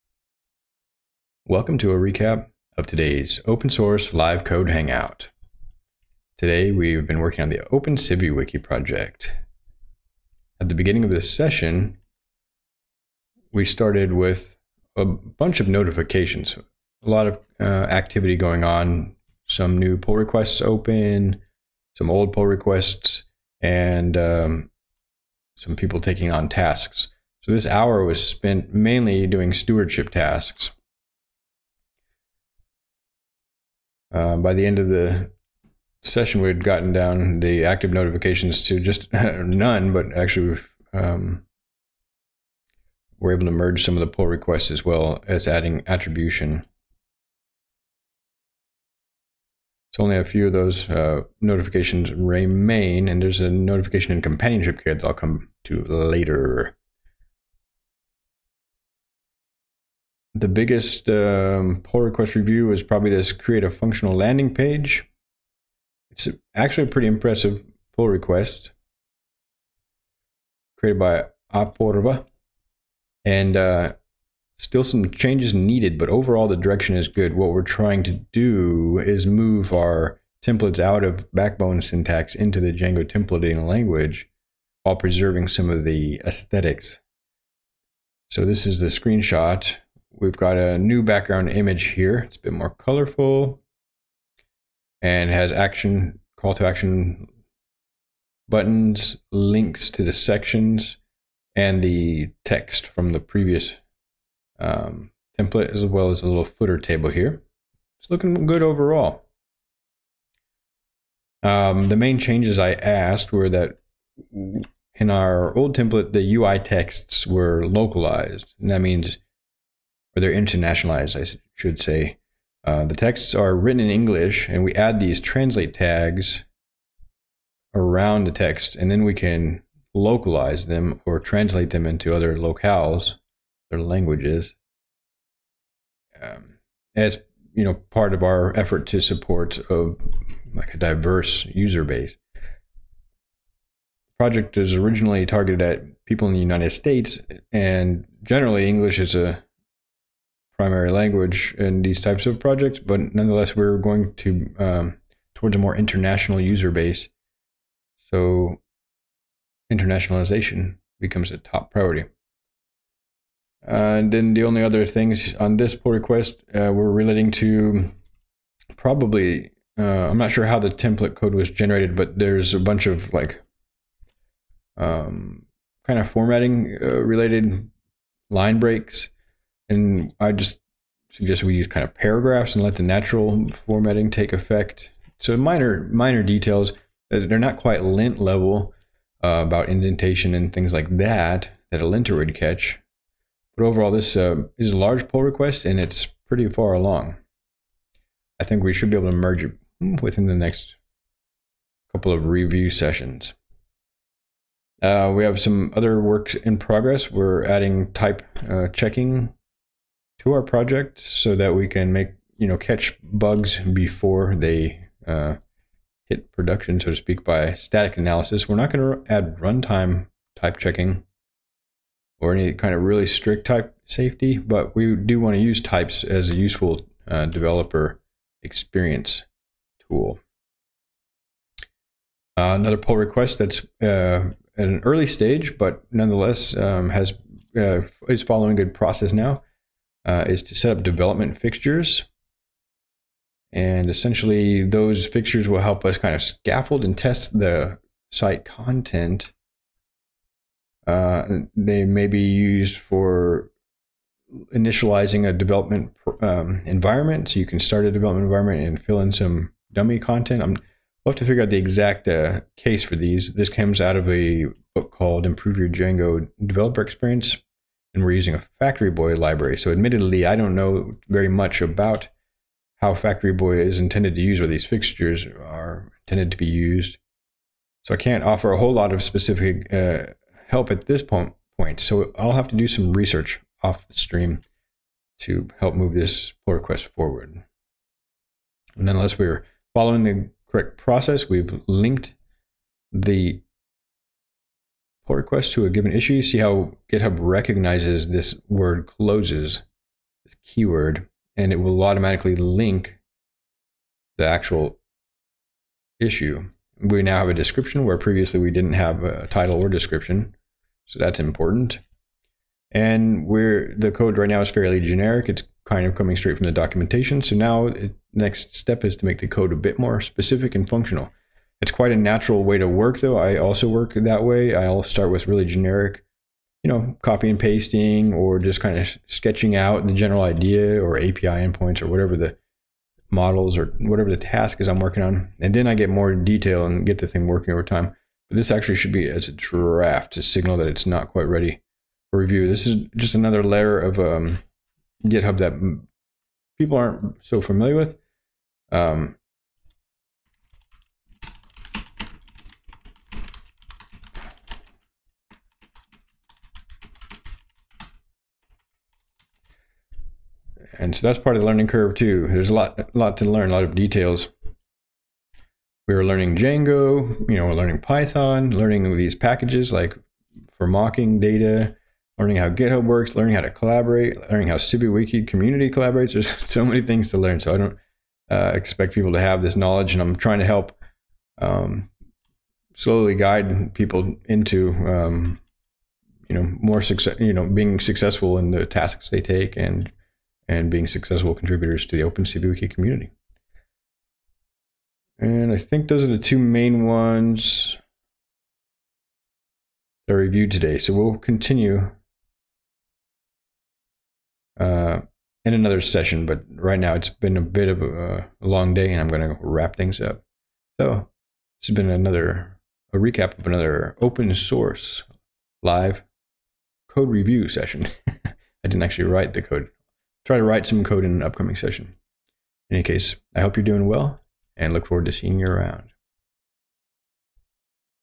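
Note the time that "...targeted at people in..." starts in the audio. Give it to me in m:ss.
2:25.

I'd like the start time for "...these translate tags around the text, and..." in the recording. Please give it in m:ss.
2:04.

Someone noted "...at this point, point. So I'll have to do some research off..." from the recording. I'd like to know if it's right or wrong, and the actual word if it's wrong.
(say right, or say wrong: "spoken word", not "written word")
right.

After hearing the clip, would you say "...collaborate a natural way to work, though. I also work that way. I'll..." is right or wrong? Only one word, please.
wrong.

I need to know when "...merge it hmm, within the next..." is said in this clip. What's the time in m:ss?
3:19.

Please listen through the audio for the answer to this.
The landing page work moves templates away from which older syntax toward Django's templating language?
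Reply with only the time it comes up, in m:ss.
1:21.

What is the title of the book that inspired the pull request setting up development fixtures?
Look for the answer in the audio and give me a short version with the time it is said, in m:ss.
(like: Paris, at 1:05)
Improve Your Django Developer Experience, at 4:25.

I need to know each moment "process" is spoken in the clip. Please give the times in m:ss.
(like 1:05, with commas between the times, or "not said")
3:58, 4:50.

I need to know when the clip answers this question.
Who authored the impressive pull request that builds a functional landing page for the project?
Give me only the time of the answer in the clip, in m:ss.
1:11.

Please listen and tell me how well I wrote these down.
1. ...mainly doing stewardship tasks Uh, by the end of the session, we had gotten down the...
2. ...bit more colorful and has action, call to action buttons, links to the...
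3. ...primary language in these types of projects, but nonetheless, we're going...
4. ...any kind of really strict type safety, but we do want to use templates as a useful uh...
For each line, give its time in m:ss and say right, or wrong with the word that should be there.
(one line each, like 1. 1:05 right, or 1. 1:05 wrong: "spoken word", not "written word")
1. 0:28 right
2. 1:32 right
3. 2:30 right
4. 3:42 wrong: "types", not "templates".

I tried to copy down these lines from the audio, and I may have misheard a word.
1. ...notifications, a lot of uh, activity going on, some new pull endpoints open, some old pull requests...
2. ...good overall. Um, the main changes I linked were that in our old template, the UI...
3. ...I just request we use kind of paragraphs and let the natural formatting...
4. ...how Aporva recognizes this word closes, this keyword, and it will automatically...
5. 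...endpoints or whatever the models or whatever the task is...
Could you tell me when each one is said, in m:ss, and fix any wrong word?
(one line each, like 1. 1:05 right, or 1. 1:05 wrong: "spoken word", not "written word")
1. 0:15 wrong: "requests", not "endpoints"
2. 1:48 wrong: "asked", not "linked"
3. 3:00 wrong: "suggest", not "request"
4. 4:56 wrong: "GitHub", not "Aporva"
5. 5:31 right.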